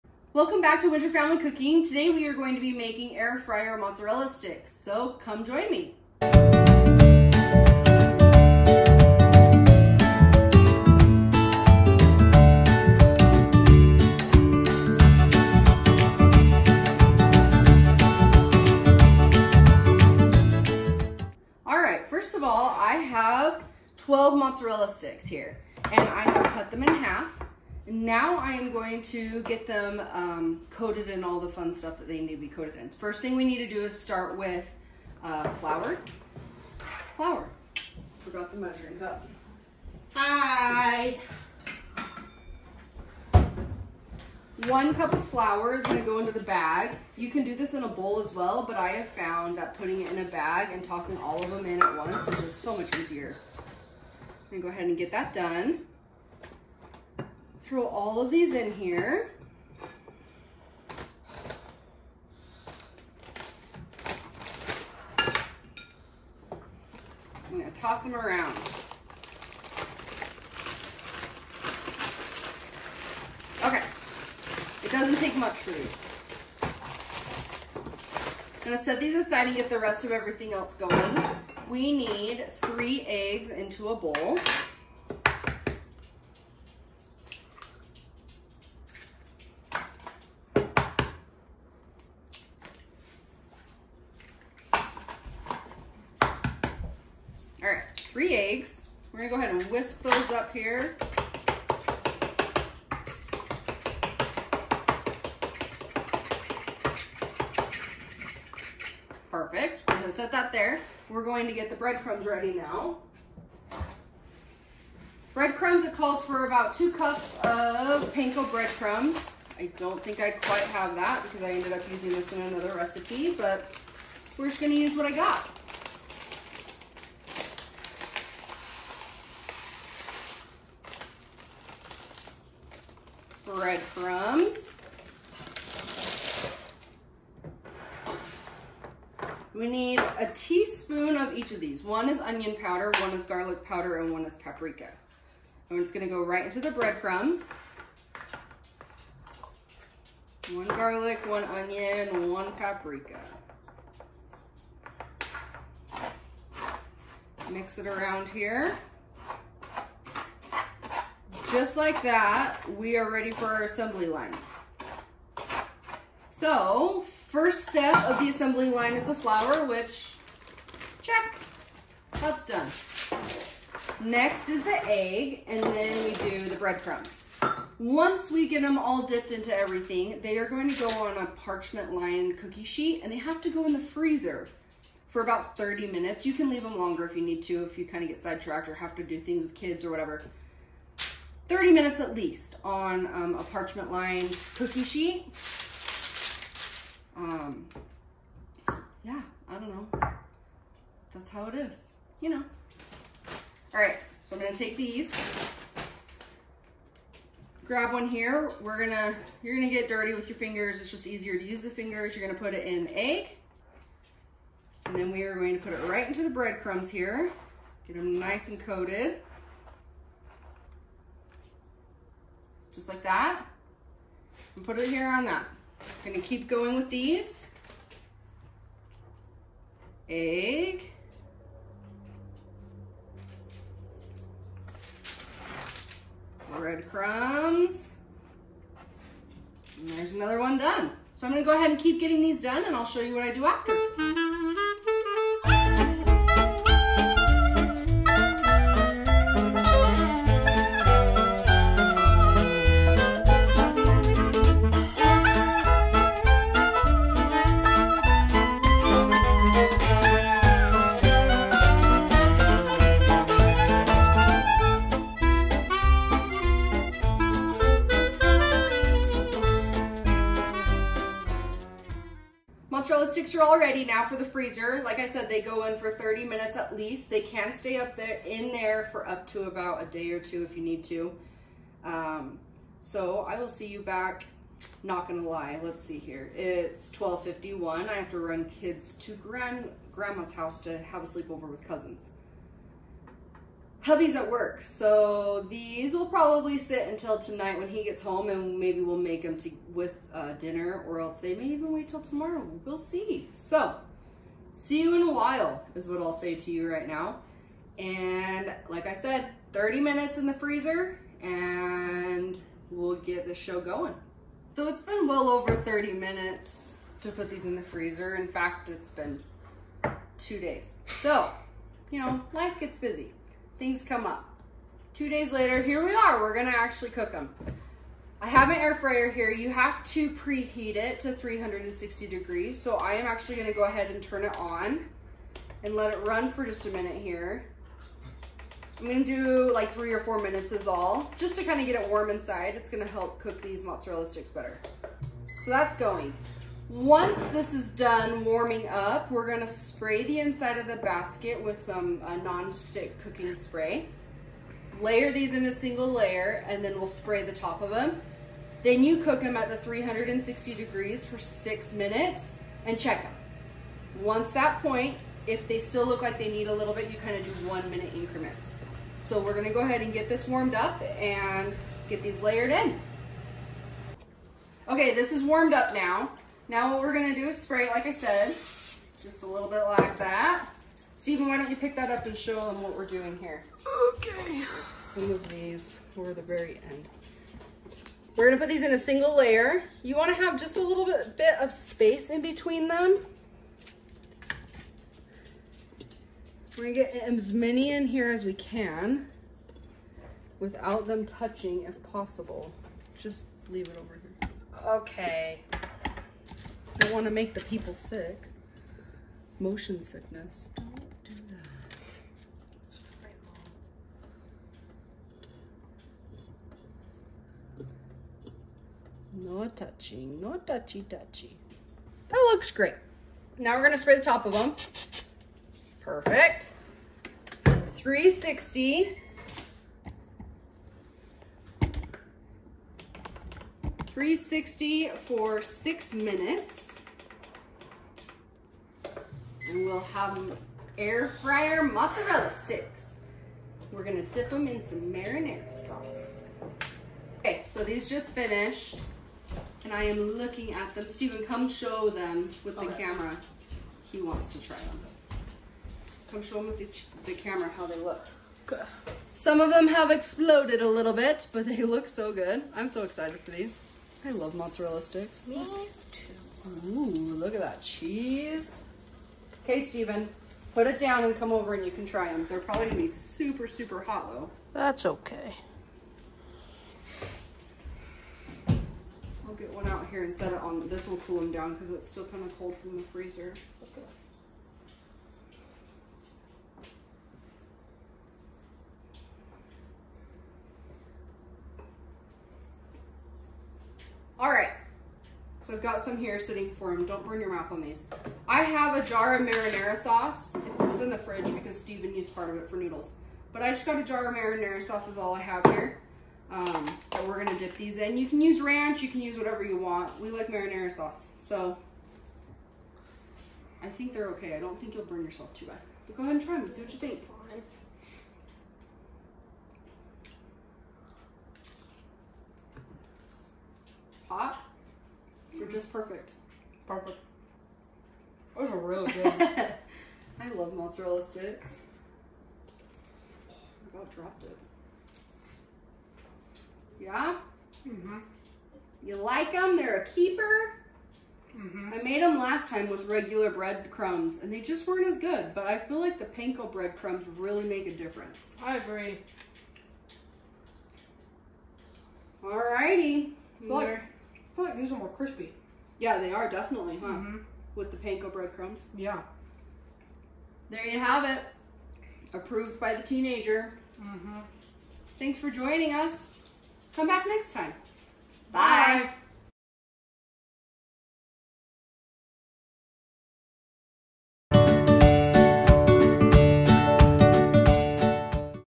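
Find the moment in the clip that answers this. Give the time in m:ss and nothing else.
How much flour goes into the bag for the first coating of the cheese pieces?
0:44.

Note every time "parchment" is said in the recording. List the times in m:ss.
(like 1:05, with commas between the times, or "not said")
3:01, 3:13.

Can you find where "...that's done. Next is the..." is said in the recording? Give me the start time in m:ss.
2:52.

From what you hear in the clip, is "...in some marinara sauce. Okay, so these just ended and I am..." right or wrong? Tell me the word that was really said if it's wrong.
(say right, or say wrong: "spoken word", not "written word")
wrong: "finished", not "ended".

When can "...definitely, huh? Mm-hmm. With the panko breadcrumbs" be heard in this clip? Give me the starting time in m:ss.
9:16.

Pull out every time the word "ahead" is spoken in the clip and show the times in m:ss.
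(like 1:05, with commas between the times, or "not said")
0:54, 1:39, 4:01, 5:33, 6:09, 8:36.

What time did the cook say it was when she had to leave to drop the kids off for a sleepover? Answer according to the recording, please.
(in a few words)
12:51.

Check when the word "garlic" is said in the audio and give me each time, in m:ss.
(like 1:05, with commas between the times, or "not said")
2:23, 2:30.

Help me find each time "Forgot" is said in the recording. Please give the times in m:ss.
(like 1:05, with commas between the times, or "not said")
0:38.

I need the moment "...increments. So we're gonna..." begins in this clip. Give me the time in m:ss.
6:07.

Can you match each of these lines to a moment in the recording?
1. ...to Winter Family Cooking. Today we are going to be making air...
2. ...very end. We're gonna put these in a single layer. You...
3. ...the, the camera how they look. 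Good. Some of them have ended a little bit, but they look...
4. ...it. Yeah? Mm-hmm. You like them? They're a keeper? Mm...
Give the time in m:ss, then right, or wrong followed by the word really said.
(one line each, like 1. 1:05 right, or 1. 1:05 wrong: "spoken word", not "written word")
1. 0:00 right
2. 6:26 right
3. 7:36 wrong: "exploded", not "ended"
4. 8:54 right.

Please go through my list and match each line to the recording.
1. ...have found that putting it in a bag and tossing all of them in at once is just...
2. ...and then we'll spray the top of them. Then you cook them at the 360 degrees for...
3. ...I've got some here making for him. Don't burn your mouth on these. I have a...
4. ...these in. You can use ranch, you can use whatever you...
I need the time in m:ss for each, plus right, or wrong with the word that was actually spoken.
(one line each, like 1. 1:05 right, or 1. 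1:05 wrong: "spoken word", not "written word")
1. 0:48 right
2. 5:56 right
3. 8:15 wrong: "sitting", not "making"
4. 8:27 right.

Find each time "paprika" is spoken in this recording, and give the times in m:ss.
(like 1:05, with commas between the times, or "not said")
2:24, 2:32.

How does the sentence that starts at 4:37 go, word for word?
They can stay up there in there for up to about a day or two if you need to.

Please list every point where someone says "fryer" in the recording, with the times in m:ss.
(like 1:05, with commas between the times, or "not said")
0:03, 5:28, 7:21.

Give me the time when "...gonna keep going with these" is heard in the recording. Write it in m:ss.
3:46.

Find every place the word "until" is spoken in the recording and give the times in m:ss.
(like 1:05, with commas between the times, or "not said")
4:56.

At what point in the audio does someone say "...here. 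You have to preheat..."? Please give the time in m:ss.
5:29.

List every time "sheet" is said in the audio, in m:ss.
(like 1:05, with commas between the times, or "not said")
3:02, 3:14.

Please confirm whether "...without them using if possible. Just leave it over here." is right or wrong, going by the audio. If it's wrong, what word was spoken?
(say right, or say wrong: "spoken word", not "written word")
wrong: "touching", not "using".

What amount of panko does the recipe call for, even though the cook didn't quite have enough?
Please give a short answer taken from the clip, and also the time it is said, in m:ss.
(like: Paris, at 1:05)
About 2 cups, at 1:56.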